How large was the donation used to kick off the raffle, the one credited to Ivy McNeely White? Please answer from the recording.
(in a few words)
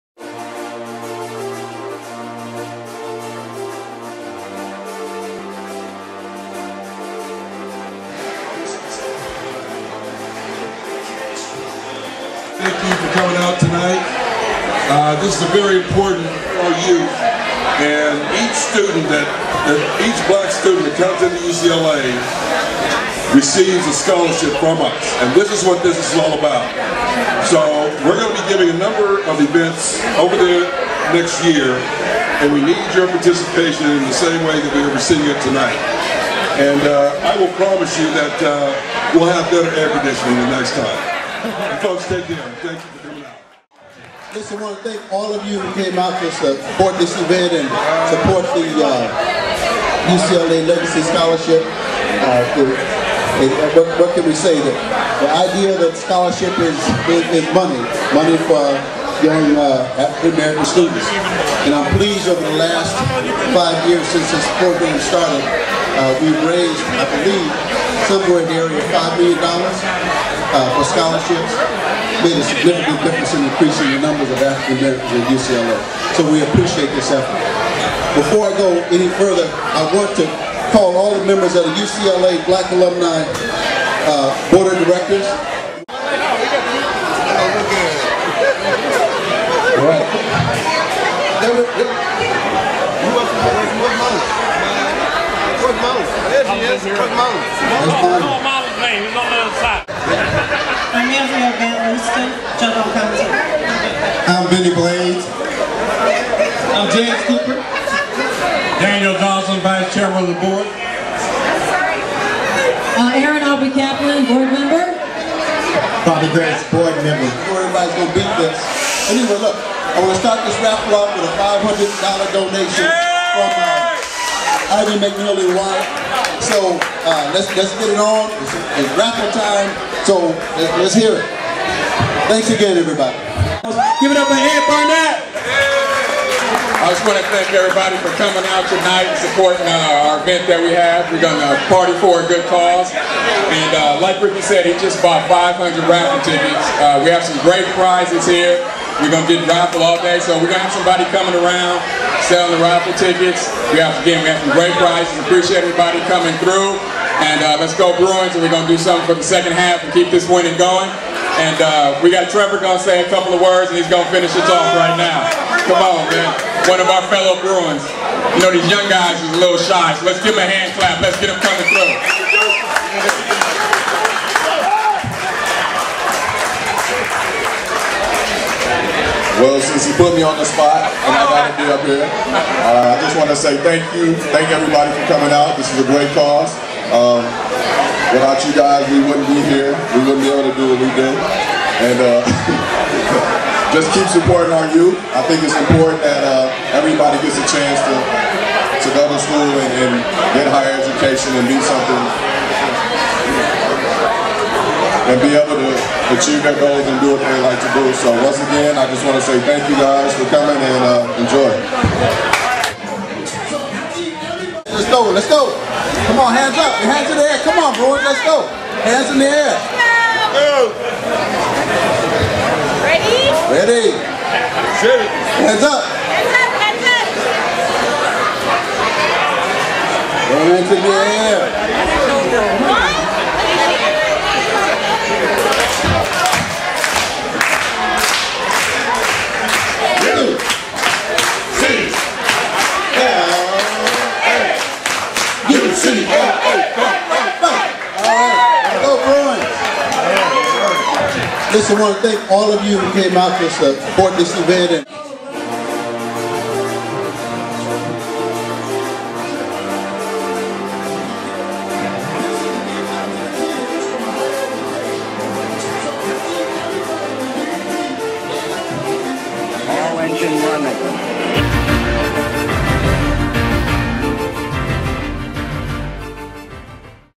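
$500.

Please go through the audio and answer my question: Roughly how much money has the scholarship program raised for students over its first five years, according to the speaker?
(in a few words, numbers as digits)
$5 million.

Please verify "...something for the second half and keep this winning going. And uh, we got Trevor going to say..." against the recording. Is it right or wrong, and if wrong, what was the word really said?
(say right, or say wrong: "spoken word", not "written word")
right.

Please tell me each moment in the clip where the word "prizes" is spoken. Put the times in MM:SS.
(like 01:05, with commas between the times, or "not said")
02:27, 02:34.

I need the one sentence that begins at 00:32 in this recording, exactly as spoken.
And we need your participation in the same way that we are receiving it tonight.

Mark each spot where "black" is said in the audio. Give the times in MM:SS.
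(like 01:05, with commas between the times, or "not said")
00:20, 01:22.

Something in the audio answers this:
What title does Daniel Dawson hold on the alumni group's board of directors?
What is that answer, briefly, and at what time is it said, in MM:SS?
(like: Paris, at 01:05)
Vice Chairman, at 01:49.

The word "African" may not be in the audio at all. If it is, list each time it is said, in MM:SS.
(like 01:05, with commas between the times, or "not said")
00:59, 01:14.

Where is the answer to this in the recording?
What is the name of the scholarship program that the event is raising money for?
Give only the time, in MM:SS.
00:50.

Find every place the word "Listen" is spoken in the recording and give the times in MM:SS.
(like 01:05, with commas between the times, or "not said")
00:44, 04:11.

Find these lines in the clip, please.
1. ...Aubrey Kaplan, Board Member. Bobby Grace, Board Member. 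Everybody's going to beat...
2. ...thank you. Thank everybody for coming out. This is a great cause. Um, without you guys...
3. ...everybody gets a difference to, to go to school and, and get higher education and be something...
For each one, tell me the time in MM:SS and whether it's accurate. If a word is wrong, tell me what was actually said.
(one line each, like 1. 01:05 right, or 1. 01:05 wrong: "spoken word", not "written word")
1. 01:53 right
2. 03:03 right
3. 03:16 wrong: "chance", not "difference".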